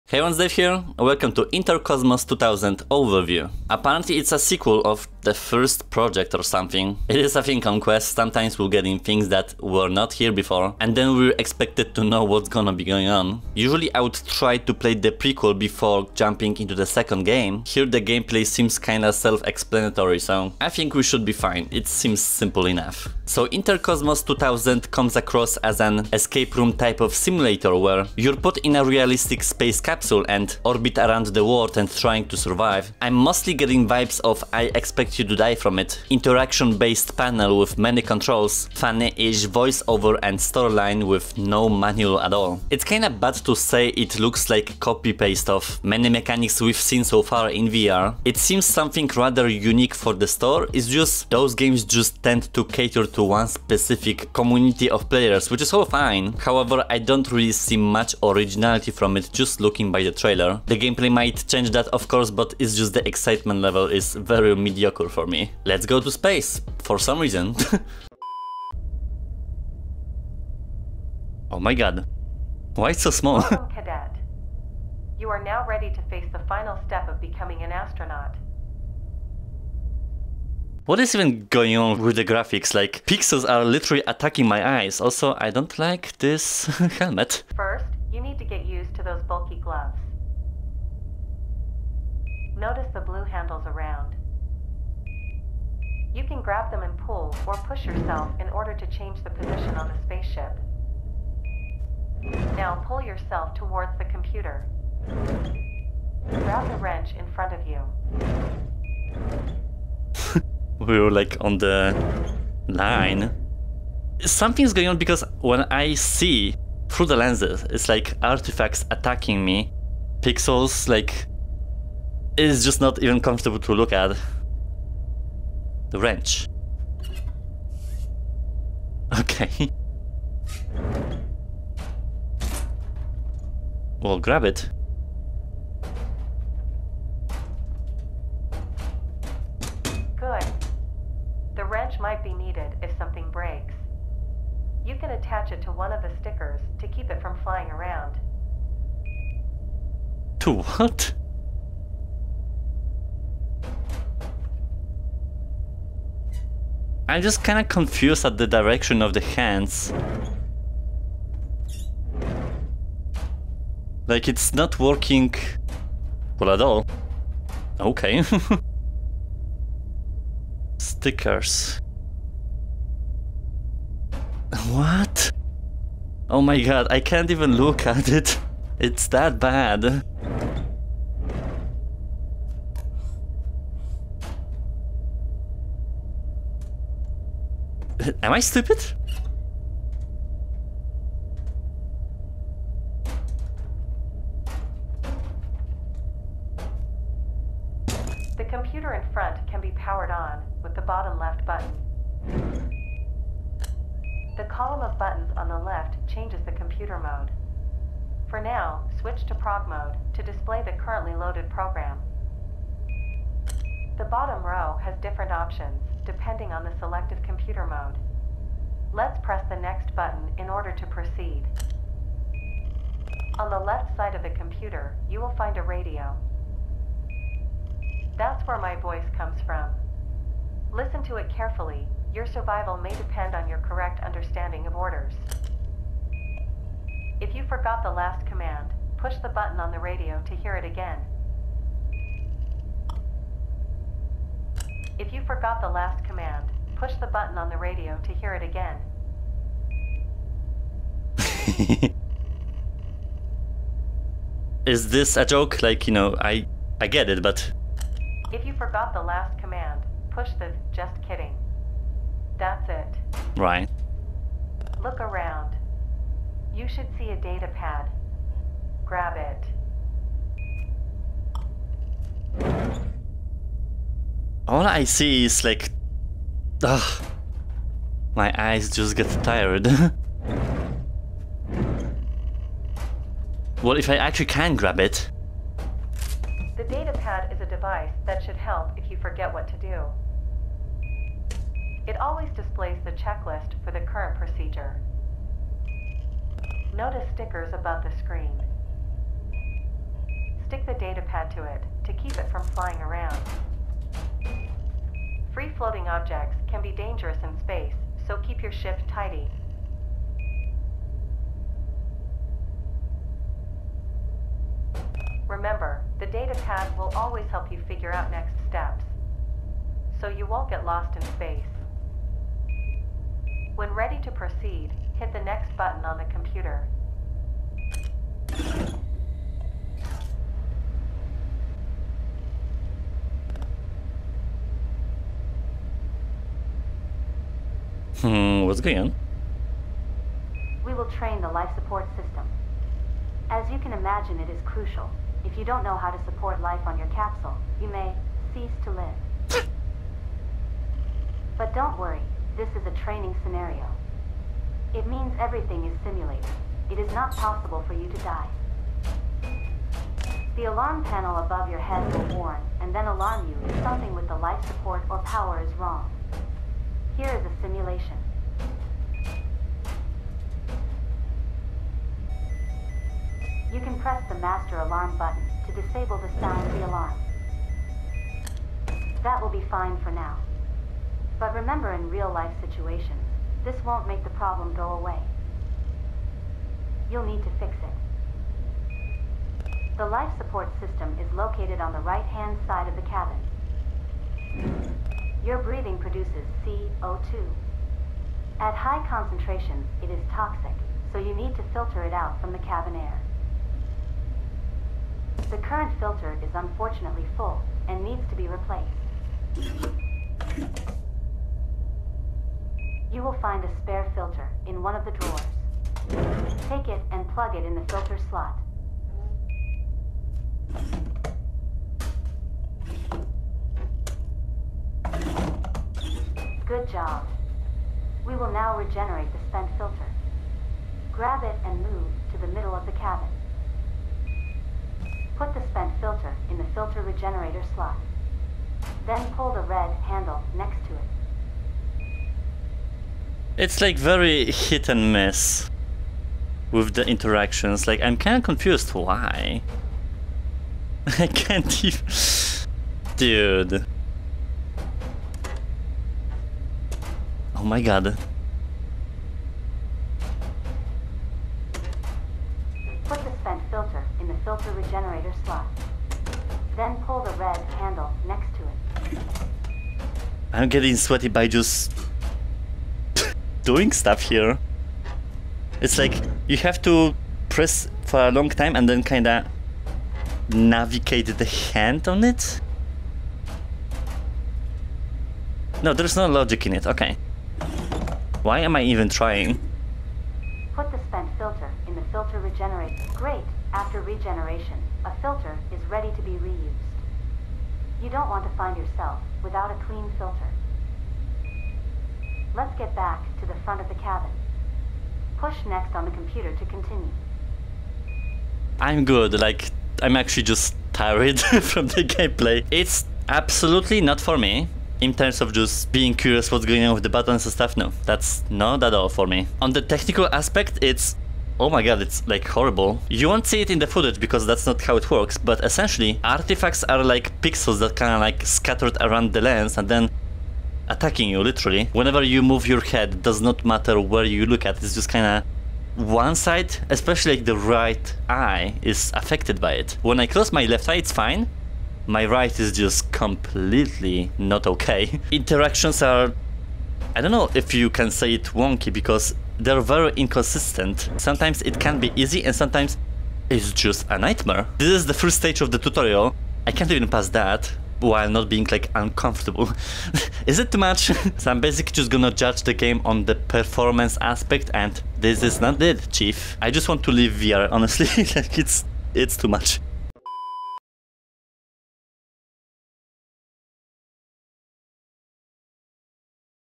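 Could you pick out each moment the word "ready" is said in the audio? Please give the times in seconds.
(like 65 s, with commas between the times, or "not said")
75 s, 323 s, 495 s.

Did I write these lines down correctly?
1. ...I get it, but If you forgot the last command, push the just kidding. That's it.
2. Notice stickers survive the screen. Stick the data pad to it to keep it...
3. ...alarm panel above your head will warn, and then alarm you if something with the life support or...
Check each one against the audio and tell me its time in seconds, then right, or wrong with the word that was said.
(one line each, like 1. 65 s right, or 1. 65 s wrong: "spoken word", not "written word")
1. 256 s right
2. 296 s wrong: "above", not "survive"
3. 360 s right.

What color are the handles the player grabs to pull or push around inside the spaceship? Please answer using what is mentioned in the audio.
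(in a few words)
Blue.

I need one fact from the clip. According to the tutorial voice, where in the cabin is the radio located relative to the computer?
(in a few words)
Left side.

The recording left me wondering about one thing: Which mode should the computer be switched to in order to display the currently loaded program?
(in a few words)
Prog mode.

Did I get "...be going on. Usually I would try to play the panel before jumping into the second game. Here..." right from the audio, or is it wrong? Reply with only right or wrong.
wrong.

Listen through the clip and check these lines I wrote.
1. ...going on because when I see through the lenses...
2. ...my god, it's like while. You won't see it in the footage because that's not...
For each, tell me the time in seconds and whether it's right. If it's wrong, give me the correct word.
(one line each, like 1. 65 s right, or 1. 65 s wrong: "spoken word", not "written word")
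1. 114 s right
2. 521 s wrong: "horrible", not "while".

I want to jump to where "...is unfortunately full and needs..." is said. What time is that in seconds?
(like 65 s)
406 s.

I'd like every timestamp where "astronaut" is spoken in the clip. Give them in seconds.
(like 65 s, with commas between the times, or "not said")
77 s.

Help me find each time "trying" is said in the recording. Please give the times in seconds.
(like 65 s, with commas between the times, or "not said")
31 s, 488 s.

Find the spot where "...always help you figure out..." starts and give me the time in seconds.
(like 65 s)
316 s.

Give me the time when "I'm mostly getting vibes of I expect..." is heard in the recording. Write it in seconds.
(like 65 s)
33 s.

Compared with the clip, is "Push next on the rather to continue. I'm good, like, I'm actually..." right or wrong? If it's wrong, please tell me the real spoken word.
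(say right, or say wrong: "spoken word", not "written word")
wrong: "computer", not "rather".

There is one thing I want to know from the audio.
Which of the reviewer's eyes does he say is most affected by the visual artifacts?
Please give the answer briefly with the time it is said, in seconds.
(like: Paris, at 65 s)
Right eye, at 537 s.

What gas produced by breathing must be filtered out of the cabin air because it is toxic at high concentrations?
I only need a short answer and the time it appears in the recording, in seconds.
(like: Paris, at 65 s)
CO2, at 396 s.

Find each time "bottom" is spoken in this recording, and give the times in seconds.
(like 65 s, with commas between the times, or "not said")
200 s, 214 s.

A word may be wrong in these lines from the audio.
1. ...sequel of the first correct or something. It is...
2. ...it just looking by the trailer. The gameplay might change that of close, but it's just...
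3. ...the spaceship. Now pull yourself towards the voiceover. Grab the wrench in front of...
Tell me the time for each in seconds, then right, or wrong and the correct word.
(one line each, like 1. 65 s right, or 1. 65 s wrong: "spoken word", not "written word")
1. 4 s wrong: "project", not "correct"
2. 59 s wrong: "course", not "close"
3. 99 s wrong: "computer", not "voiceover".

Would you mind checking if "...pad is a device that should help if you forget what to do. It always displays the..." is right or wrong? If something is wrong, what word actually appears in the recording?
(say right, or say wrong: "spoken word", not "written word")
right.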